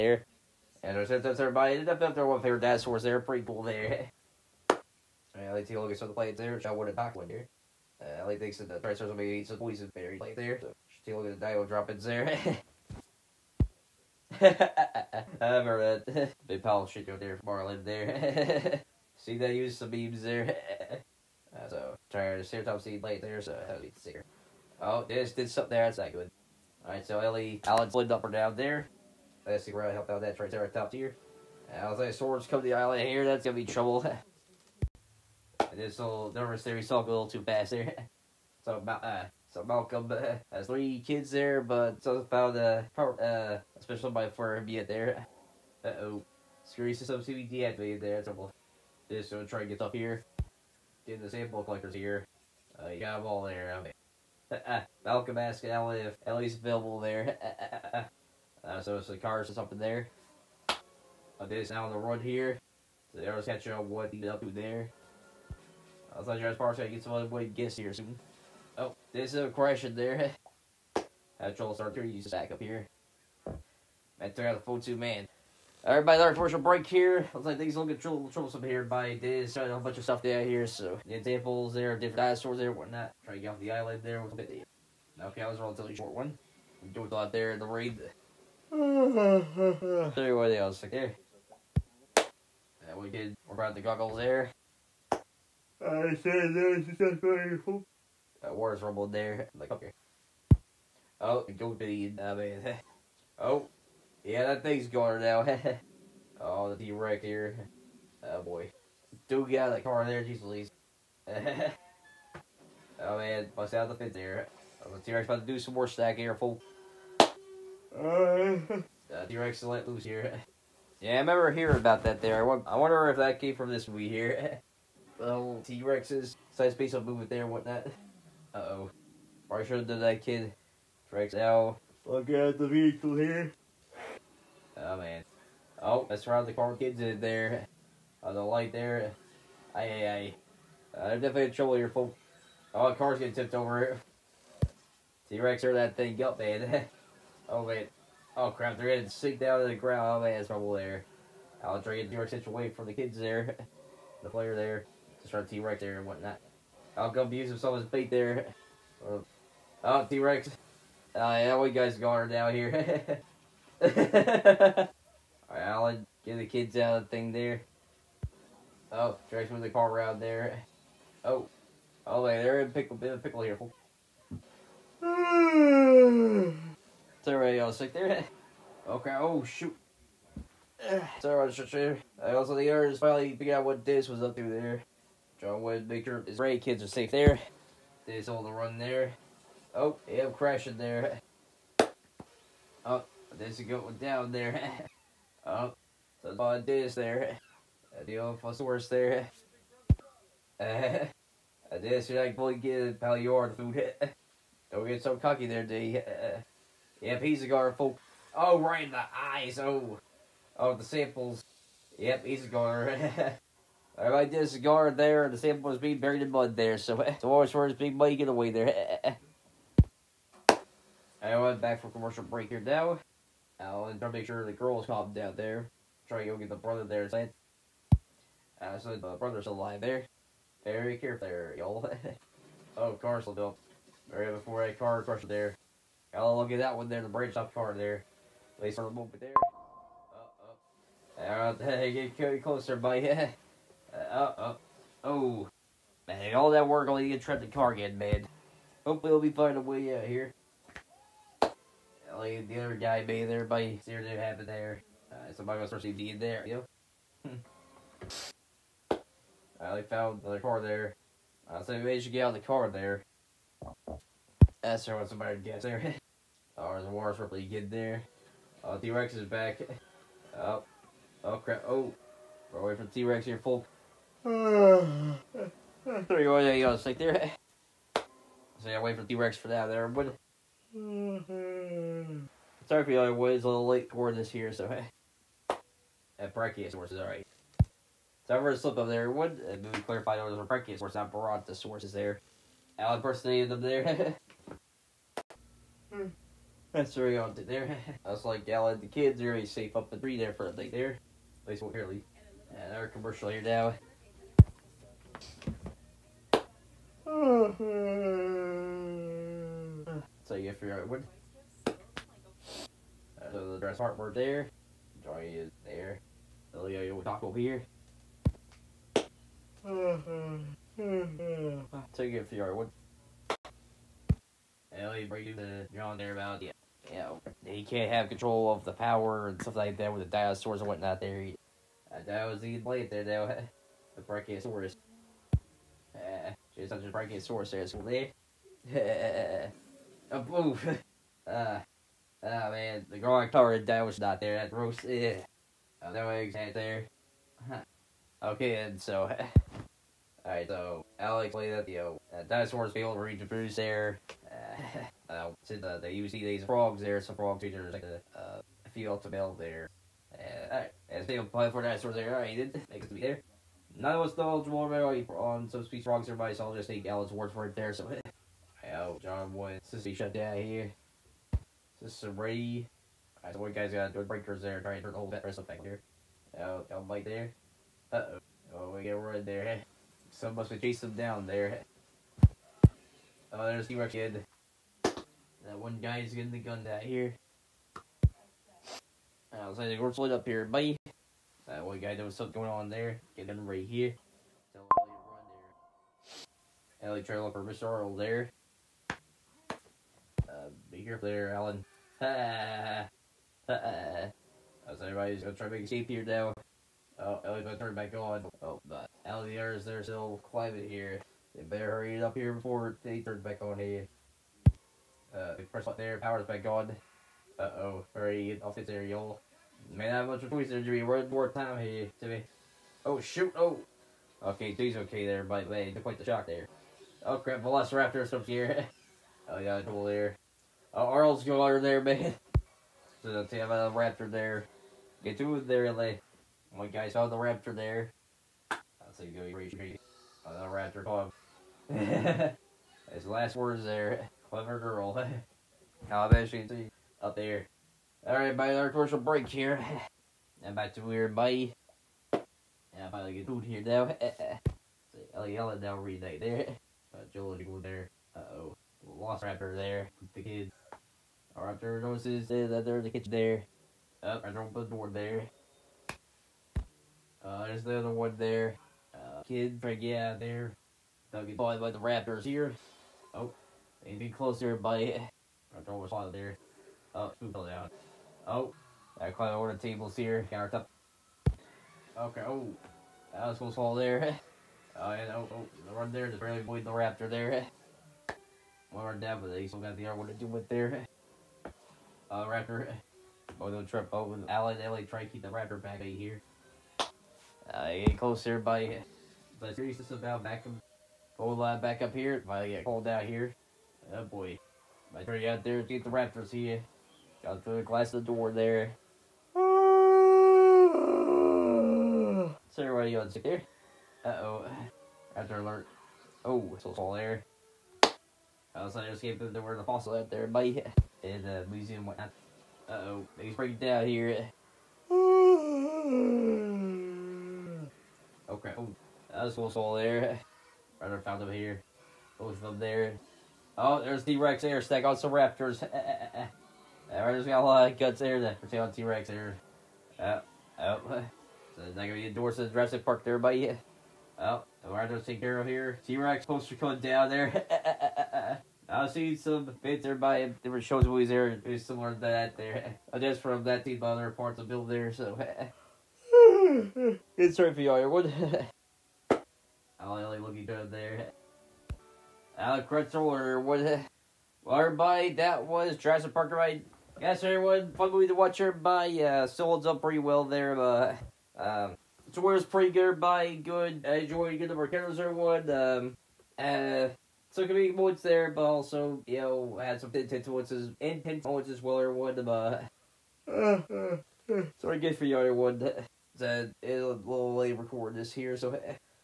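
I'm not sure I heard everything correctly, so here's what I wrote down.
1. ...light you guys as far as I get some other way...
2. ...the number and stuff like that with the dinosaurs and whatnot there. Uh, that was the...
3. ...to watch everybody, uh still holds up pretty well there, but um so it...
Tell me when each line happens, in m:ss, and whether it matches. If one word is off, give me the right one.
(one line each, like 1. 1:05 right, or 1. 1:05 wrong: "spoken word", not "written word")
1. 1:06 wrong: "thought", not "light"
2. 5:28 wrong: "power", not "number"
3. 9:28 right.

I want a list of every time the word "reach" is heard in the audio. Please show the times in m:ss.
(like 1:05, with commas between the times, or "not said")
5:53, 7:19.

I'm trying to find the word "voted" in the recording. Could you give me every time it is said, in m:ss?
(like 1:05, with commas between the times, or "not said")
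not said.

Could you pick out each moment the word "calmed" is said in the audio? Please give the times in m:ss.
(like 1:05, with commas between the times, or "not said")
3:44.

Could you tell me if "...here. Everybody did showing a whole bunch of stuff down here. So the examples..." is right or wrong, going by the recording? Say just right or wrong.
right.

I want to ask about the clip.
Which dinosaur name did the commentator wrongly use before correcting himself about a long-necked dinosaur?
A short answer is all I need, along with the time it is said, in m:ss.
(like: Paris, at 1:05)
Brontosaurus, at 4:51.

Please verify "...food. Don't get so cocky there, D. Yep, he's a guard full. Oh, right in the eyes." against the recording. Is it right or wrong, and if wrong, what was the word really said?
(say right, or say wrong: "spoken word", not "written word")
right.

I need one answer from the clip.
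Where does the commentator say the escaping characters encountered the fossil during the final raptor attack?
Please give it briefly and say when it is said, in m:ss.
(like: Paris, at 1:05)
the museum, at 8:41.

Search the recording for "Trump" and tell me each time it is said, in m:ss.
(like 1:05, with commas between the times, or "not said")
8:13.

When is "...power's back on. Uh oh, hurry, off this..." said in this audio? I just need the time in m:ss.
6:55.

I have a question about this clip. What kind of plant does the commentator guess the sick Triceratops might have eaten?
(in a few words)
poison berry plant.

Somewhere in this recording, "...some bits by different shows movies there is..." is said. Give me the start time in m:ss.
9:09.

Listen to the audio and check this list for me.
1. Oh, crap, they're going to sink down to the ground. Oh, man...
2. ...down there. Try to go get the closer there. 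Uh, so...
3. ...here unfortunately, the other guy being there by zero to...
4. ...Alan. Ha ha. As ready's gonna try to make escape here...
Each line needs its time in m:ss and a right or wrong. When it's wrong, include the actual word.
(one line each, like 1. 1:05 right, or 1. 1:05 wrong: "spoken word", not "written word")
1. 2:28 right
2. 3:45 wrong: "brother", not "closer"
3. 4:10 right
4. 6:41 wrong: "everybody", not "ready".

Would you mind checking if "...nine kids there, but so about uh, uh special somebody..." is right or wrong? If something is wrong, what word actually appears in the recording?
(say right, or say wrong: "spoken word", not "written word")
wrong: "three", not "nine".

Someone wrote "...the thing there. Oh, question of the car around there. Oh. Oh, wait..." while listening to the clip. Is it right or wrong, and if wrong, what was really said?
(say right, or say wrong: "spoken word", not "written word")
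wrong: "direction", not "question".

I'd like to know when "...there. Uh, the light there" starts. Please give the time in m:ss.
2:17.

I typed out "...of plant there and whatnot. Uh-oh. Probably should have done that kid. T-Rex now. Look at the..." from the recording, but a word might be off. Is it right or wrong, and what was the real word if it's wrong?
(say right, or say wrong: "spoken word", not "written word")
wrong: "movement", not "plant".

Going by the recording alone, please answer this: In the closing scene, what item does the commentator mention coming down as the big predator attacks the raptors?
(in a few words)
T-Rex poster.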